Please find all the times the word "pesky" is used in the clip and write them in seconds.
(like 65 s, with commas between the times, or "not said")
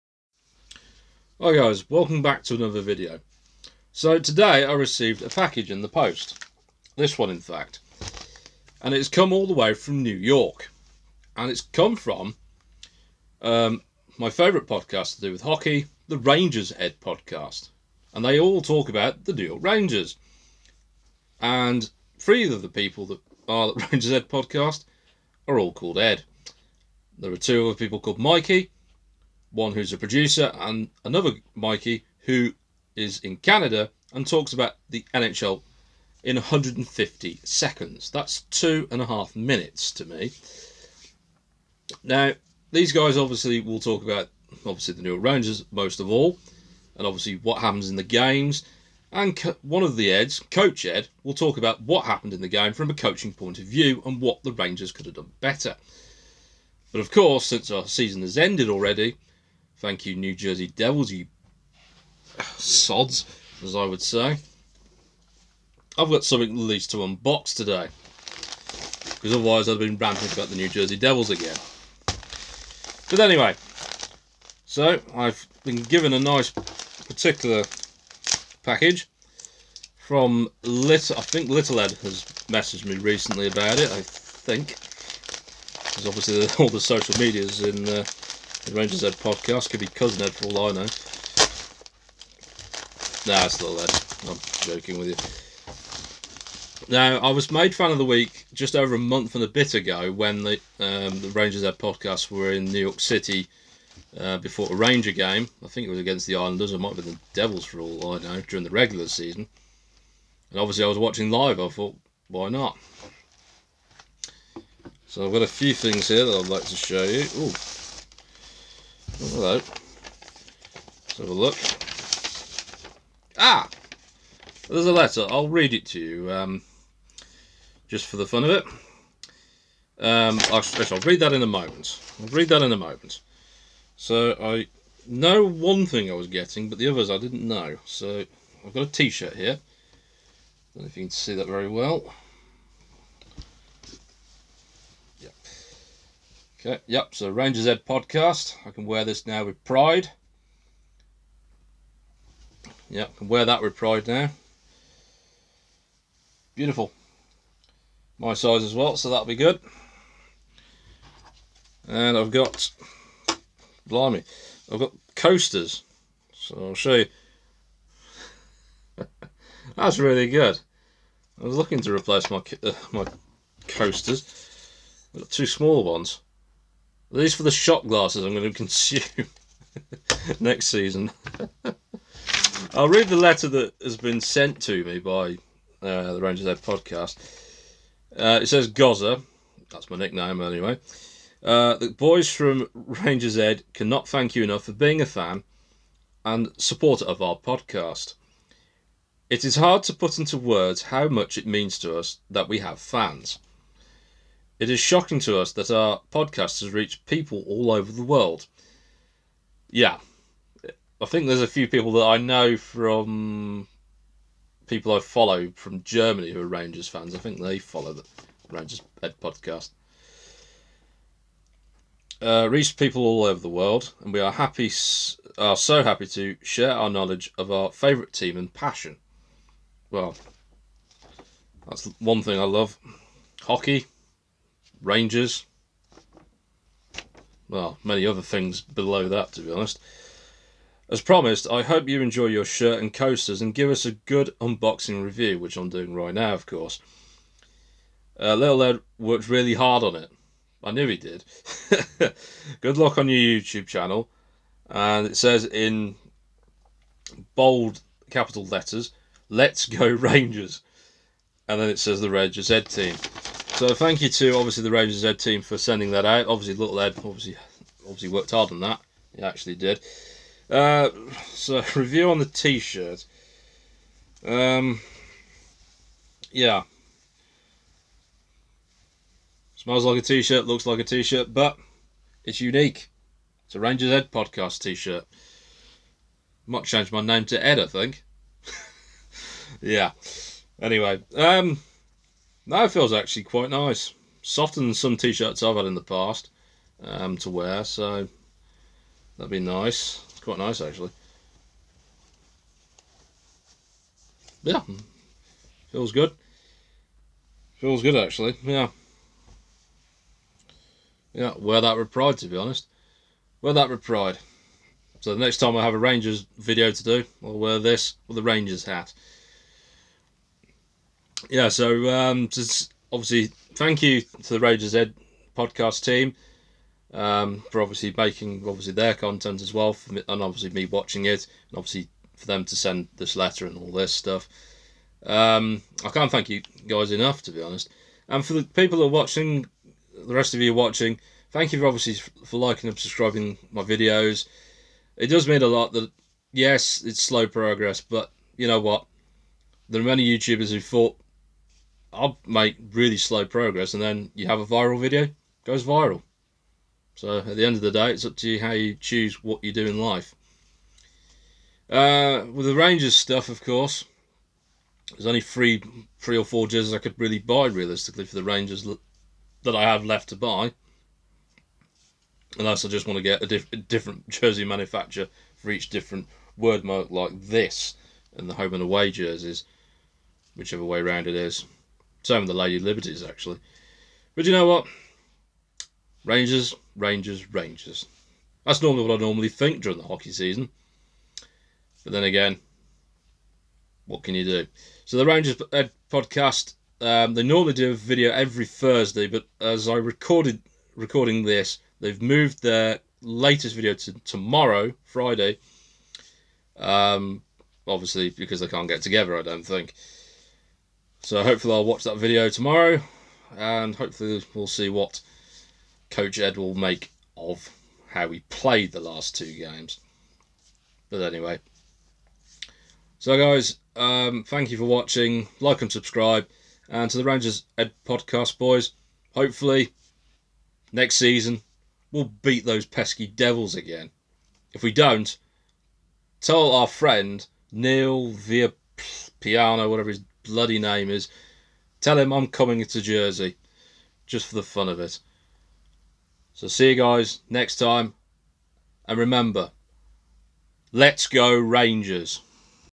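432 s.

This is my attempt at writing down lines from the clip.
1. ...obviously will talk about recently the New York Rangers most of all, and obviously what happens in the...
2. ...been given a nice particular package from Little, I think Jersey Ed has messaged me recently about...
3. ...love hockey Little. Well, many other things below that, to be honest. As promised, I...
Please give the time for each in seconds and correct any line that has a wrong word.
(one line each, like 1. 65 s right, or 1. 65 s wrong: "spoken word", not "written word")
1. 43 s wrong: "obviously", not "recently"
2. 75 s wrong: "Little", not "Jersey"
3. 232 s wrong: "Rangers", not "Little".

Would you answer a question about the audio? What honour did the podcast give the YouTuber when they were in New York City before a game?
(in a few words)
Fan of the week.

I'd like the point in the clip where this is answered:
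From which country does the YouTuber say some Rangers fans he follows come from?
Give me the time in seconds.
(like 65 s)
215 s.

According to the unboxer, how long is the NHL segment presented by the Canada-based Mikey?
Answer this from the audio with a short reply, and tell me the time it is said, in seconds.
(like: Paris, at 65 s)
150 seconds, at 36 s.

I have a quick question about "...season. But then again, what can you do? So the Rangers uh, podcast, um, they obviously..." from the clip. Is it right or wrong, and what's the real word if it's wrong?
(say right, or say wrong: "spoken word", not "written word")
wrong: "normally", not "obviously".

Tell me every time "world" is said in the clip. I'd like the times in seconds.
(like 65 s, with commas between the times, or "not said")
208 s, 223 s.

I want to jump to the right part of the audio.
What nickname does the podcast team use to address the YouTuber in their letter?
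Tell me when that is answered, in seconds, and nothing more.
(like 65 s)
188 s.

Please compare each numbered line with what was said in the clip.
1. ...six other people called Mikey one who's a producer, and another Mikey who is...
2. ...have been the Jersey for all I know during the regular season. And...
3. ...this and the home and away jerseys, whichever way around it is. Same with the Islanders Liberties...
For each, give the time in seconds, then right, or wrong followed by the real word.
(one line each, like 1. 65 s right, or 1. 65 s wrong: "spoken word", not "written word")
1. 27 s wrong: "two", not "six"
2. 106 s wrong: "Devils", not "Jersey"
3. 377 s wrong: "Lady", not "Islanders".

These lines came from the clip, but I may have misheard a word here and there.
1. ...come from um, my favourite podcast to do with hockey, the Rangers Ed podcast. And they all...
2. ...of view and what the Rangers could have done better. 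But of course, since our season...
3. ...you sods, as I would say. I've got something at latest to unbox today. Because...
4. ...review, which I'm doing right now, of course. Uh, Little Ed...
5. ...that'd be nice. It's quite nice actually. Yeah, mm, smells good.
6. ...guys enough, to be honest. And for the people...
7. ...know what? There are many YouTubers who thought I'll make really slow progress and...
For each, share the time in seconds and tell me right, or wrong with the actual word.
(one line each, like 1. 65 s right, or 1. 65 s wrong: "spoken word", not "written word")
1. 11 s right
2. 53 s right
3. 61 s wrong: "least", not "latest"
4. 245 s right
5. 299 s wrong: "feels", not "smells"
6. 336 s right
7. 348 s right.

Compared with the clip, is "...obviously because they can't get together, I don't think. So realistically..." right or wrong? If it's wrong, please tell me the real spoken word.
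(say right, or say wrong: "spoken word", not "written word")
wrong: "hopefully", not "realistically".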